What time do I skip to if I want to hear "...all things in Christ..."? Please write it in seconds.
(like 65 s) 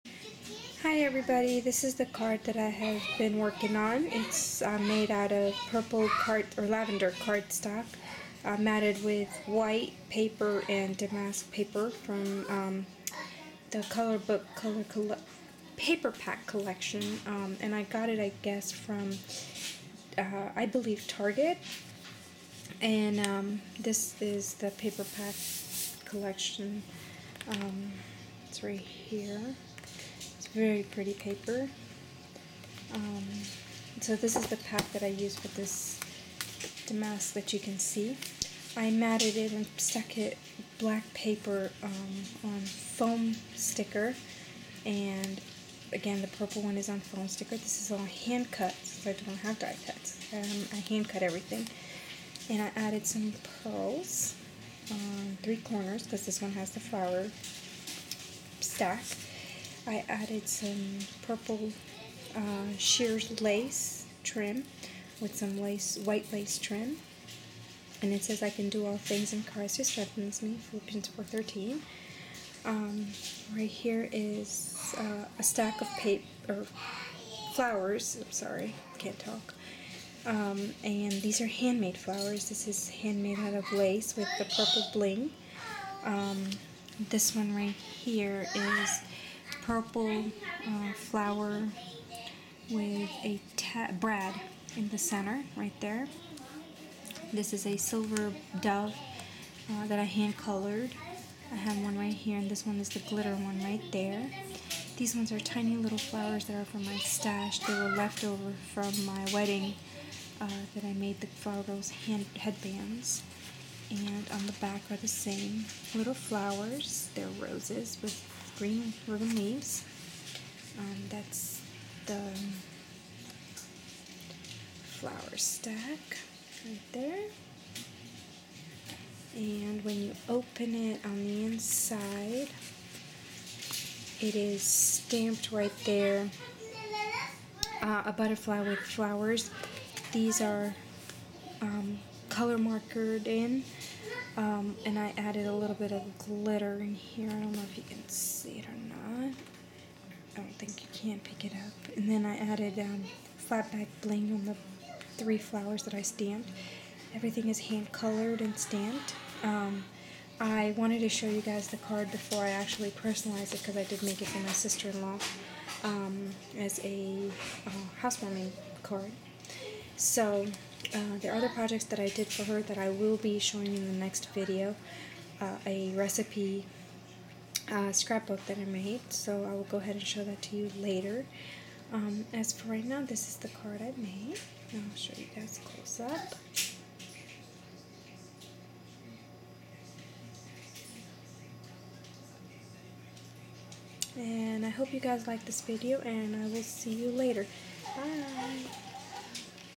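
68 s.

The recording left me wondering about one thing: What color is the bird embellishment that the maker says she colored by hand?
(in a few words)
Silver.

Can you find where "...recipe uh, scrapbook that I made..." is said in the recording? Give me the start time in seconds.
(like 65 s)
175 s.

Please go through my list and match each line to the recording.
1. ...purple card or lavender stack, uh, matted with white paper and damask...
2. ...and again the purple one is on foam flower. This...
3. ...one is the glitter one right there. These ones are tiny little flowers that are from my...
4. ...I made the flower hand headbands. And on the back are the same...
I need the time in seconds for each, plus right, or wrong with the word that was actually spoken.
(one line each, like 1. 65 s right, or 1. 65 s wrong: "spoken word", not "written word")
1. 5 s wrong: "cardstock", not "stack"
2. 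44 s wrong: "sticker", not "flower"
3. 102 s right
4. 110 s right.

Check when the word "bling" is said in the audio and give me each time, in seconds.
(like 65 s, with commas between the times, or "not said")
84 s, 154 s.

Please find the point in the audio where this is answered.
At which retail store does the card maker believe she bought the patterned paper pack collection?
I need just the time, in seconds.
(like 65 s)
21 s.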